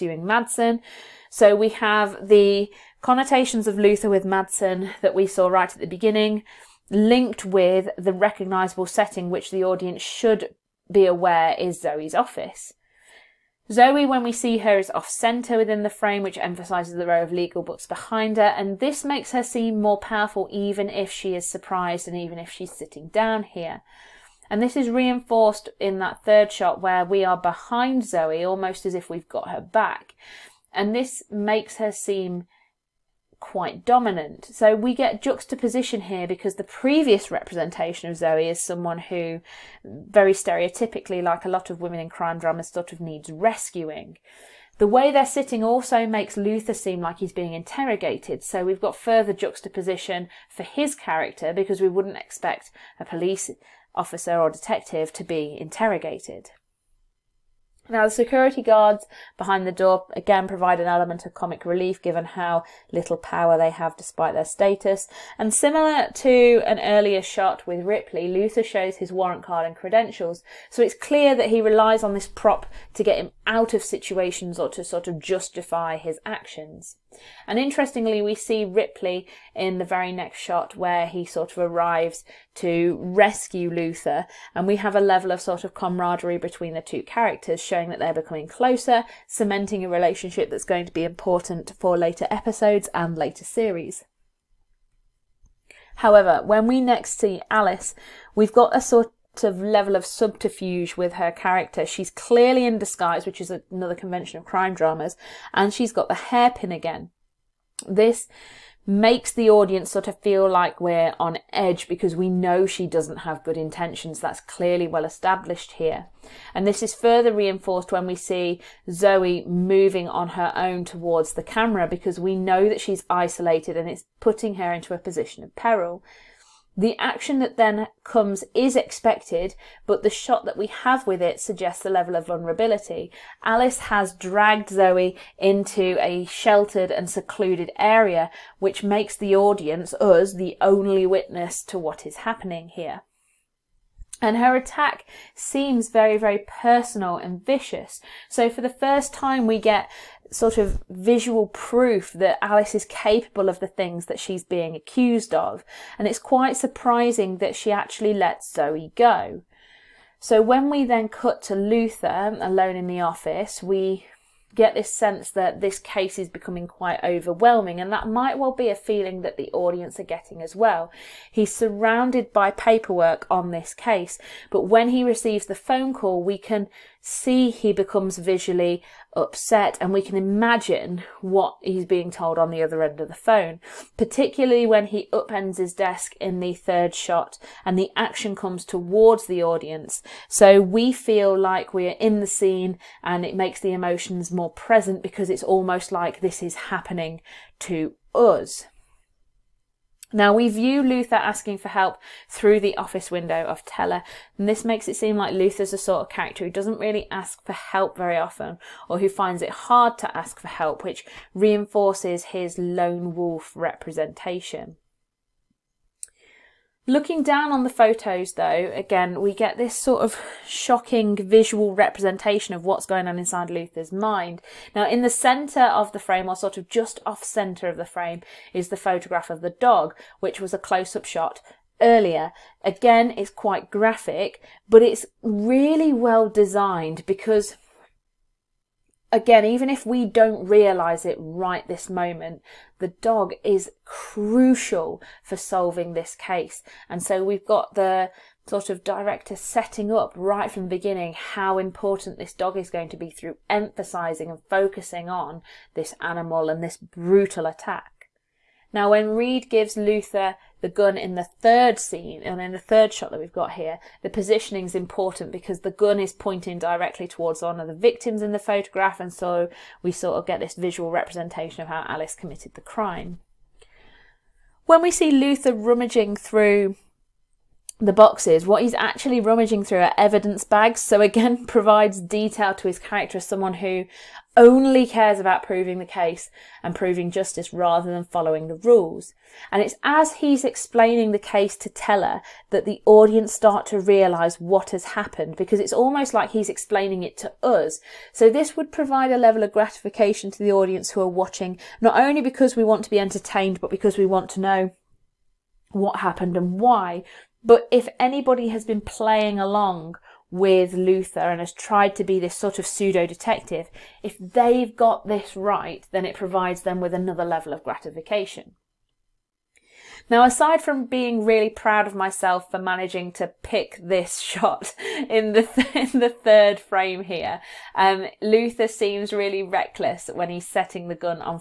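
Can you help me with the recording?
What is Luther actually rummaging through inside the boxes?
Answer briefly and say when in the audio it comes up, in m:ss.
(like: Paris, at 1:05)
Evidence bags, at 4:39.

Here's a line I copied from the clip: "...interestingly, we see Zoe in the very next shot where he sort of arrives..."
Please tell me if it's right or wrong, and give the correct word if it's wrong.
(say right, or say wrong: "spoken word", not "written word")
wrong: "Ripley", not "Zoe".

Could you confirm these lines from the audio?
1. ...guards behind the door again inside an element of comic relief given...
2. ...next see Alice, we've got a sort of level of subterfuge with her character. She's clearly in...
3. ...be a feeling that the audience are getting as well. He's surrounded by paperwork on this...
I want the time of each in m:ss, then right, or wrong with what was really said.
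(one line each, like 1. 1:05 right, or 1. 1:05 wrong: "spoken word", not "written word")
1. 0:58 wrong: "provide", not "inside"
2. 1:36 right
3. 2:48 right.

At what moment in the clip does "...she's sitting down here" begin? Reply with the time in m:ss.
0:22.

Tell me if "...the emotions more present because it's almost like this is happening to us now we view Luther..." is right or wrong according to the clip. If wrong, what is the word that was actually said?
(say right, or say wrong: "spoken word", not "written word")
right.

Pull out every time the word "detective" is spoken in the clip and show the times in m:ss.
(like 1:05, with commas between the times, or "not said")
0:54, 5:13.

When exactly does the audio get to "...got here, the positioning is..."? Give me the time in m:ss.
4:23.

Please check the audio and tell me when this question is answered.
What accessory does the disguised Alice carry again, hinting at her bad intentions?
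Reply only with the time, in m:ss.
1:46.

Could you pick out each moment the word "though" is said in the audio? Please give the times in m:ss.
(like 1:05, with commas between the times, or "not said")
3:38.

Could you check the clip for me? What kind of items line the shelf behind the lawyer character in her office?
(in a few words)
Legal books.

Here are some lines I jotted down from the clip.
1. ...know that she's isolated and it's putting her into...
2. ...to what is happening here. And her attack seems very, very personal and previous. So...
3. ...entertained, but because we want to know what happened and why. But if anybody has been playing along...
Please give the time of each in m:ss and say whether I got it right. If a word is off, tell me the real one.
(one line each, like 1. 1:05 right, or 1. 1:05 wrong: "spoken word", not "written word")
1. 2:02 right
2. 2:21 wrong: "vicious", not "previous"
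3. 5:02 right.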